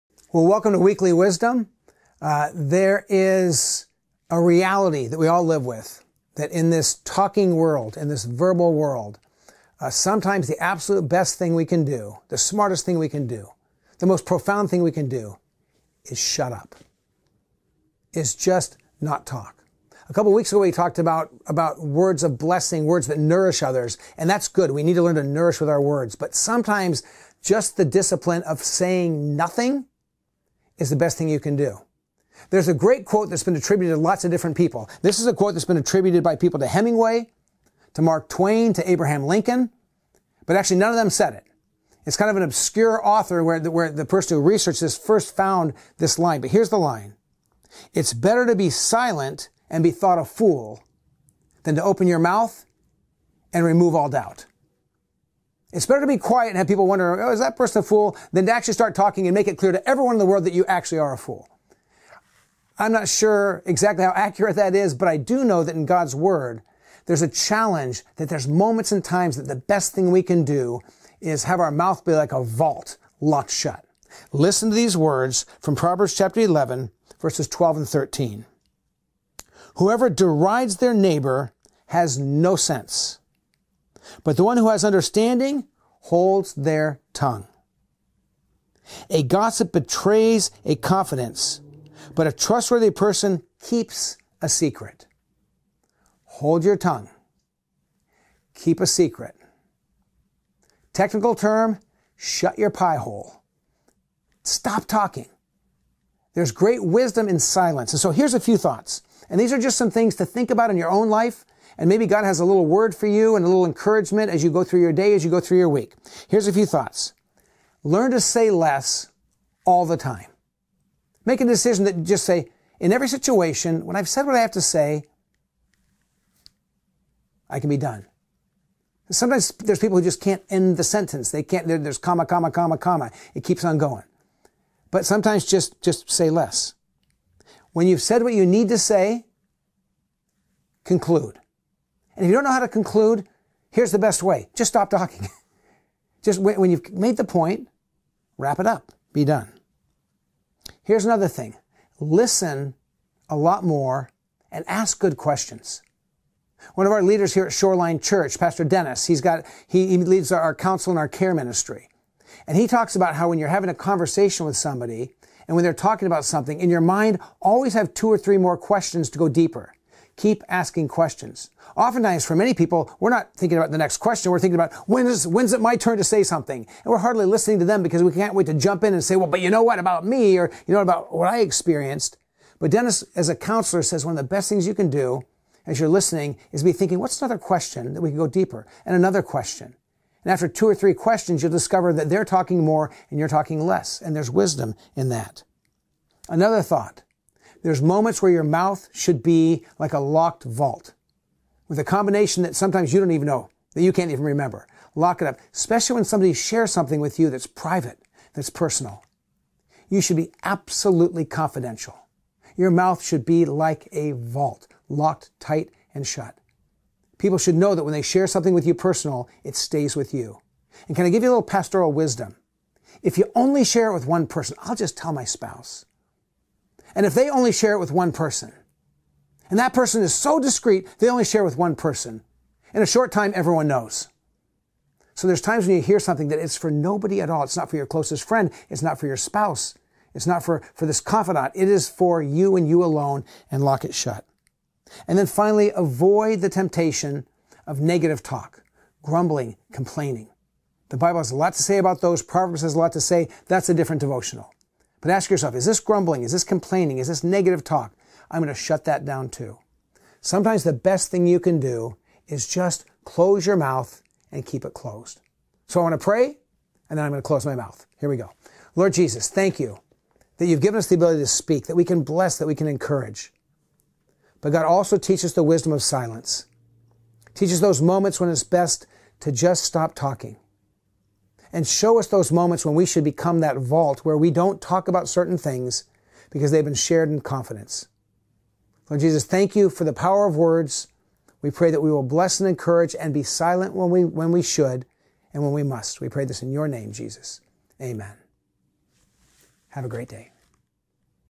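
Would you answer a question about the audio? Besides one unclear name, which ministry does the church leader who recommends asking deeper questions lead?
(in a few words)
care ministry.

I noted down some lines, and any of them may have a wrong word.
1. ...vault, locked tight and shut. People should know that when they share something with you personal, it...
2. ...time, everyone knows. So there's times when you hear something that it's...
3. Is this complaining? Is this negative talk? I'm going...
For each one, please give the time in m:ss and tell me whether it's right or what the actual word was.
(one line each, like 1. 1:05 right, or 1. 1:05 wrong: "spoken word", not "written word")
1. 3:34 right
2. 3:53 right
3. 4:16 right.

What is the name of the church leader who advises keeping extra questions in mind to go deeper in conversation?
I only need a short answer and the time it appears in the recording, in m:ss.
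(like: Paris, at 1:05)
Pastor Dennis, at 2:38.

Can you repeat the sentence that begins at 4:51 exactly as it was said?
We pray that we will bless and encourage and be silent when we, when we should and when we must.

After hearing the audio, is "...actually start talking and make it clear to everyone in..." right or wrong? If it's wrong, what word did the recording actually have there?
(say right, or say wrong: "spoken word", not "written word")
right.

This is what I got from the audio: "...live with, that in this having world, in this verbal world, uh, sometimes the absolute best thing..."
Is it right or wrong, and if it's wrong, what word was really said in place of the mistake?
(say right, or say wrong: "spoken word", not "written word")
wrong: "talking", not "having".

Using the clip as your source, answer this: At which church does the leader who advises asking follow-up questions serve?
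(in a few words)
Shoreline Church.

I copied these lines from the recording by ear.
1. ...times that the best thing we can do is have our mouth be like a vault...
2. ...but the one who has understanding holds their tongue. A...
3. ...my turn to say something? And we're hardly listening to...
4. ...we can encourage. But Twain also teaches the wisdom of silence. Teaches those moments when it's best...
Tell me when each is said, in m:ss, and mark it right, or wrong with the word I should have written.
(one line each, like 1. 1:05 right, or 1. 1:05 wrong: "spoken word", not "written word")
1. 1:09 right
2. 1:24 right
3. 2:55 right
4. 4:32 wrong: "God", not "Twain".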